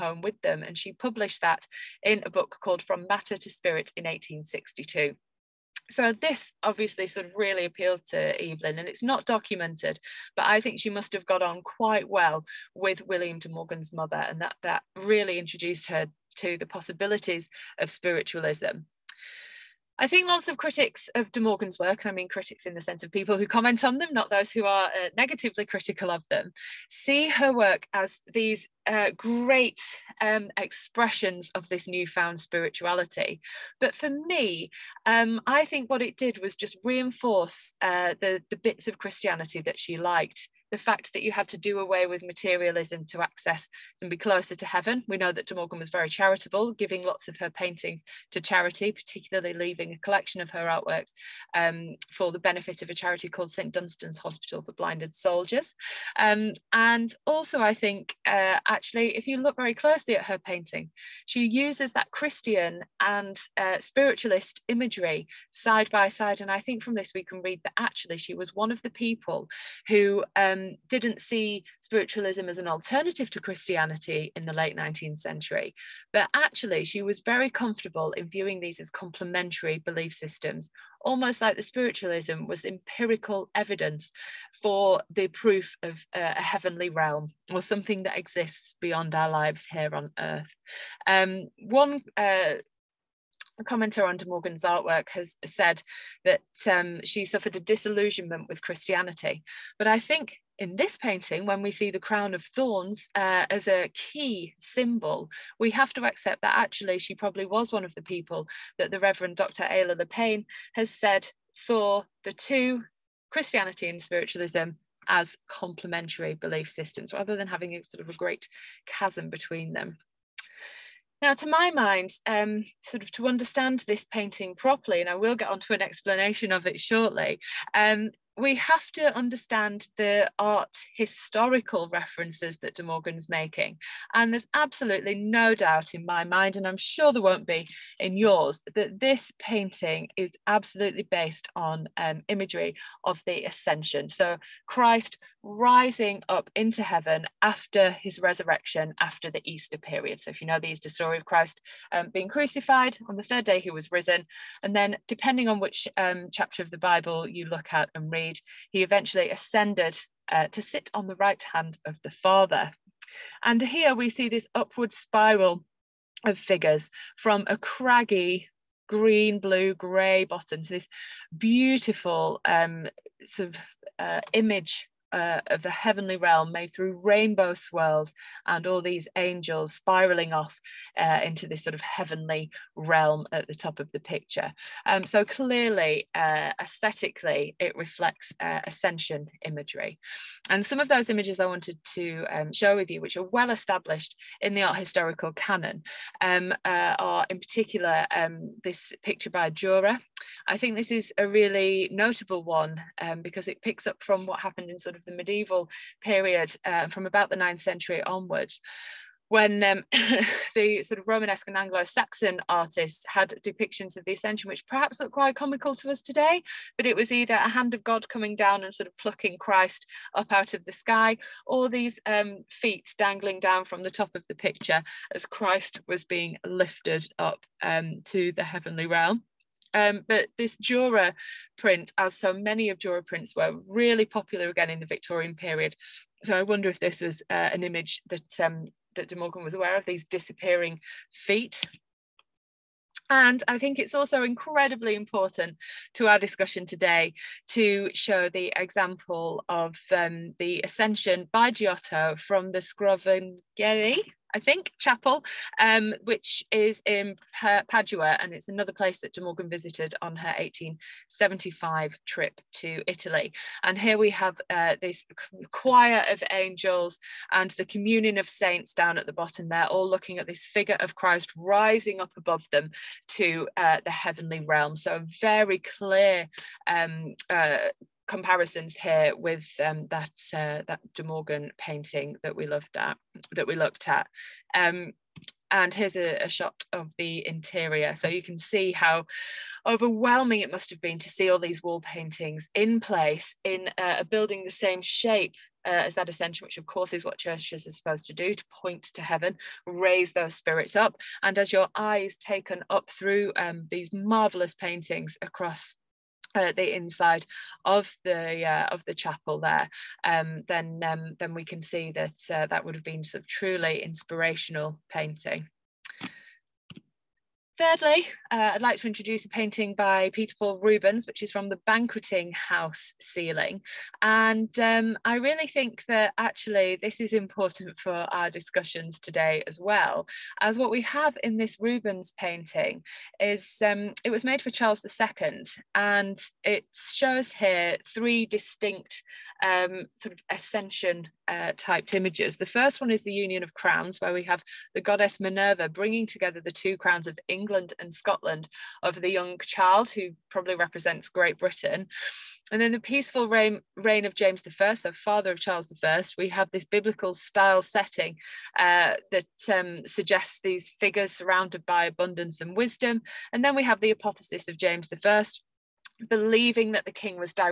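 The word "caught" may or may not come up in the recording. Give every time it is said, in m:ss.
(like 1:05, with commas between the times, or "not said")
not said.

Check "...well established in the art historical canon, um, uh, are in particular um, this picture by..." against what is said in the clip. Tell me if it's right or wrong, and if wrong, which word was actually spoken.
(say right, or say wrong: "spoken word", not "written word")
right.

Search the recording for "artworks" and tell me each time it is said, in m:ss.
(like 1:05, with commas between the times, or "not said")
0:50, 1:34.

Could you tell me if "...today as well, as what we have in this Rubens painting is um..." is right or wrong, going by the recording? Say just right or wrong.
right.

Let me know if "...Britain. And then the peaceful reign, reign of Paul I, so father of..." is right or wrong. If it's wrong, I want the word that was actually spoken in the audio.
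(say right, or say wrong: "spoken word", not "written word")
wrong: "James", not "Paul".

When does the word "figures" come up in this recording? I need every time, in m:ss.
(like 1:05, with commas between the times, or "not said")
2:46, 4:30, 6:00.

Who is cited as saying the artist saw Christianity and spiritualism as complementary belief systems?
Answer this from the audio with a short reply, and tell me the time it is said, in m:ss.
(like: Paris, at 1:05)
Reverend Dr. Ayla Lepine, at 1:48.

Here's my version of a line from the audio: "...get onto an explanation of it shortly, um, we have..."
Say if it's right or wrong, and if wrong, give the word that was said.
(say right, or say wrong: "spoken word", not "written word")
right.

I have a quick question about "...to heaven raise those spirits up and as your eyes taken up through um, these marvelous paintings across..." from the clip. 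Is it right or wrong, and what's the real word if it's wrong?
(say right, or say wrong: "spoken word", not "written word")
right.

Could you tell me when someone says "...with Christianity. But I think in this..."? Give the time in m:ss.
1:38.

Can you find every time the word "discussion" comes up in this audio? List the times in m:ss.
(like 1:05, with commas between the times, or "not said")
4:06, 5:28.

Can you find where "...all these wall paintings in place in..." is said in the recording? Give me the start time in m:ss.
4:51.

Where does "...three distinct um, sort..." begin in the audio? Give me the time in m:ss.
5:37.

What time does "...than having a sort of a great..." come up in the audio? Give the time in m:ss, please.
1:57.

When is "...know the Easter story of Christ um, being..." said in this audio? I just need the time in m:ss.
2:30.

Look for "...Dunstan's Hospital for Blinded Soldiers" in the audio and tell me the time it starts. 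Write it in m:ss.
0:53.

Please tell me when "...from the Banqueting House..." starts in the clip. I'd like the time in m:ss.
5:21.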